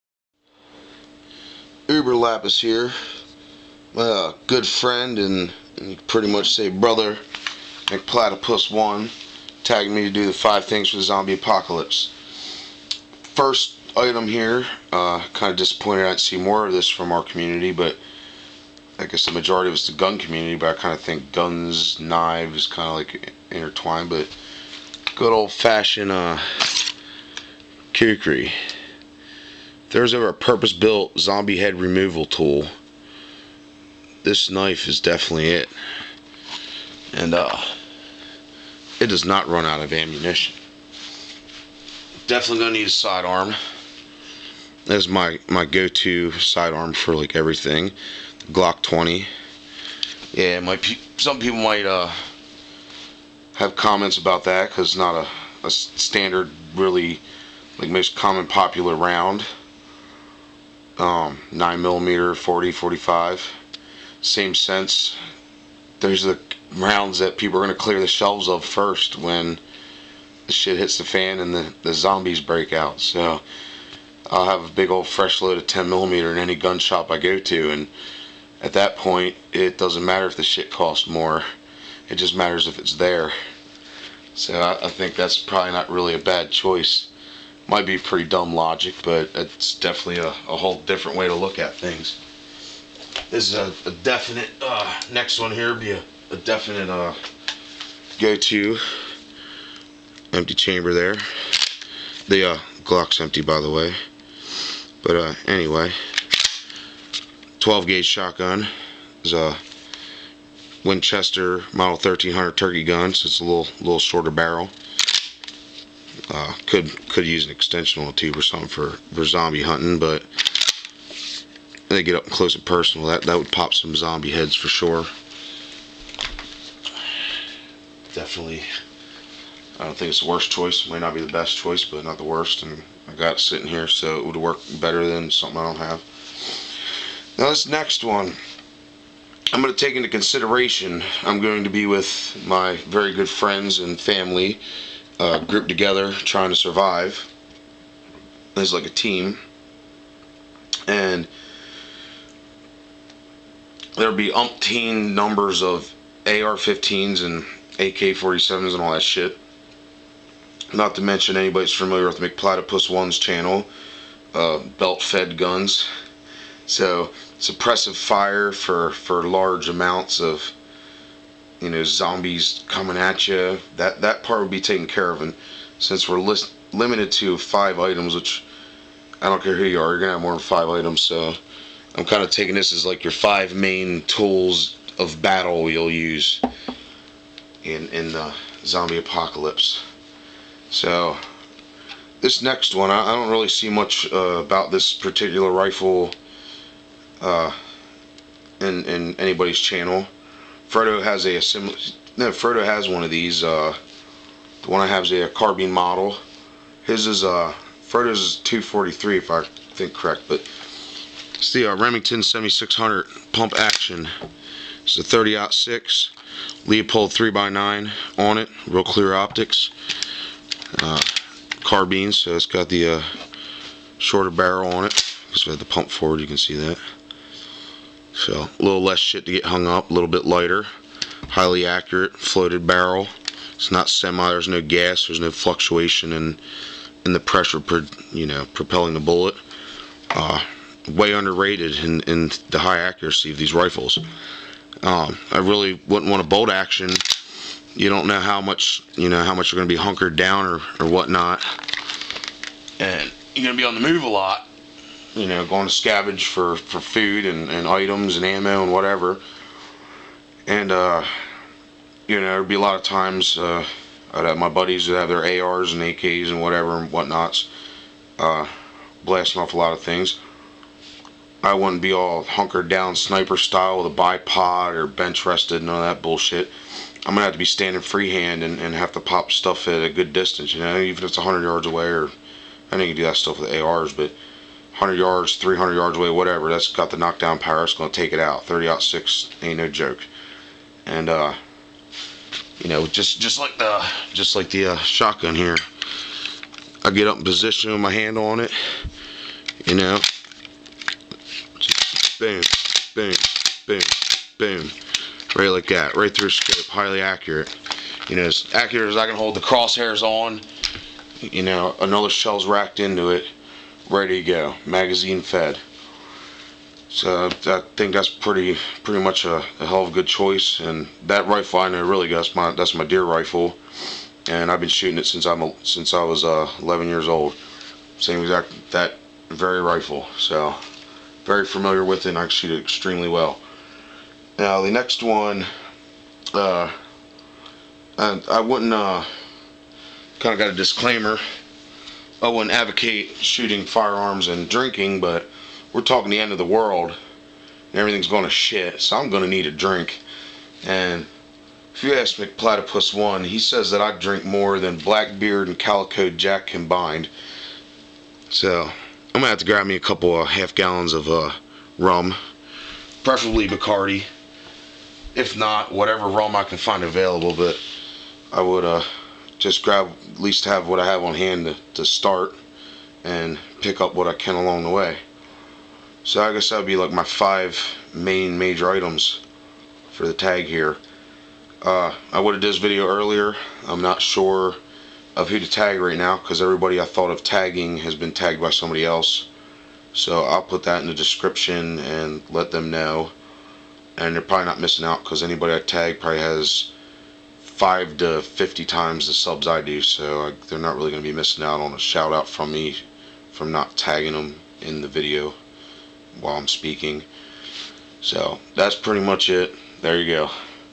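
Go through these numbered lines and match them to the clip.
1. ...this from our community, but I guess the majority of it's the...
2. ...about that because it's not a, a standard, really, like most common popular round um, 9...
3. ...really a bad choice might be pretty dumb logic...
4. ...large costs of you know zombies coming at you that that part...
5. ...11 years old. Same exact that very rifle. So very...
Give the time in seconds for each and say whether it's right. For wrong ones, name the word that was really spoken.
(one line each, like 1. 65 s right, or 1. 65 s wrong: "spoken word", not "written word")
1. 16 s right
2. 54 s right
3. 85 s right
4. 169 s wrong: "amounts", not "costs"
5. 326 s right.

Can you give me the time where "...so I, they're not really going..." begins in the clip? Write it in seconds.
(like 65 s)
399 s.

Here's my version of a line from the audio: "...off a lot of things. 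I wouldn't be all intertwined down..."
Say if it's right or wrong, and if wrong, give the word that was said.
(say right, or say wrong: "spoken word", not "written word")
wrong: "hunkered", not "intertwined".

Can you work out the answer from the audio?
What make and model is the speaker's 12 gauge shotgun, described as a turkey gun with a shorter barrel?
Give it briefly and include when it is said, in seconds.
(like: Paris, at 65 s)
Winchester Model 1300, at 110 s.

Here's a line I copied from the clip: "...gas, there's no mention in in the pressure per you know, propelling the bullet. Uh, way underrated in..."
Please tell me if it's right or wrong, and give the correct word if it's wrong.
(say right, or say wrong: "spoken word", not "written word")
wrong: "fluctuation", not "mention".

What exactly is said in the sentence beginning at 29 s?
There's a purpose built zombie head removal tool.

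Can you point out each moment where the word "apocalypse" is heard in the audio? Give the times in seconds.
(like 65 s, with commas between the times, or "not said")
11 s, 188 s.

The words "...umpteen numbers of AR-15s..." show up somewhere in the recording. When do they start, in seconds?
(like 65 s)
154 s.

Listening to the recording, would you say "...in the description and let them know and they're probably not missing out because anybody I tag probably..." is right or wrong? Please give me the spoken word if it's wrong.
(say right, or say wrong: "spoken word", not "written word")
right.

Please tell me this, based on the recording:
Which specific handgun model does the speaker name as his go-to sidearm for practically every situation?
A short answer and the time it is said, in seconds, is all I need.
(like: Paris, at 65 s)
Glock 20, at 48 s.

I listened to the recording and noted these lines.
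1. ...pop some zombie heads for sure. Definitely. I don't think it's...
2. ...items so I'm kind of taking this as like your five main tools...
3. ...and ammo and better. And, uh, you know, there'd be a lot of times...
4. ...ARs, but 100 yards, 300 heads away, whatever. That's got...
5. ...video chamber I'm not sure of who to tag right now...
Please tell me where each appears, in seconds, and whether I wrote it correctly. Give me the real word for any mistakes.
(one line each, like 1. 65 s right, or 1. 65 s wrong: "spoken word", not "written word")
1. 123 s right
2. 180 s right
3. 258 s wrong: "whatever", not "better"
4. 283 s wrong: "yards", not "heads"
5. 382 s wrong: "earlier", not "chamber".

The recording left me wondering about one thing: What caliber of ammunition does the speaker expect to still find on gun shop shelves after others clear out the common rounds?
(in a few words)
10 millimeter.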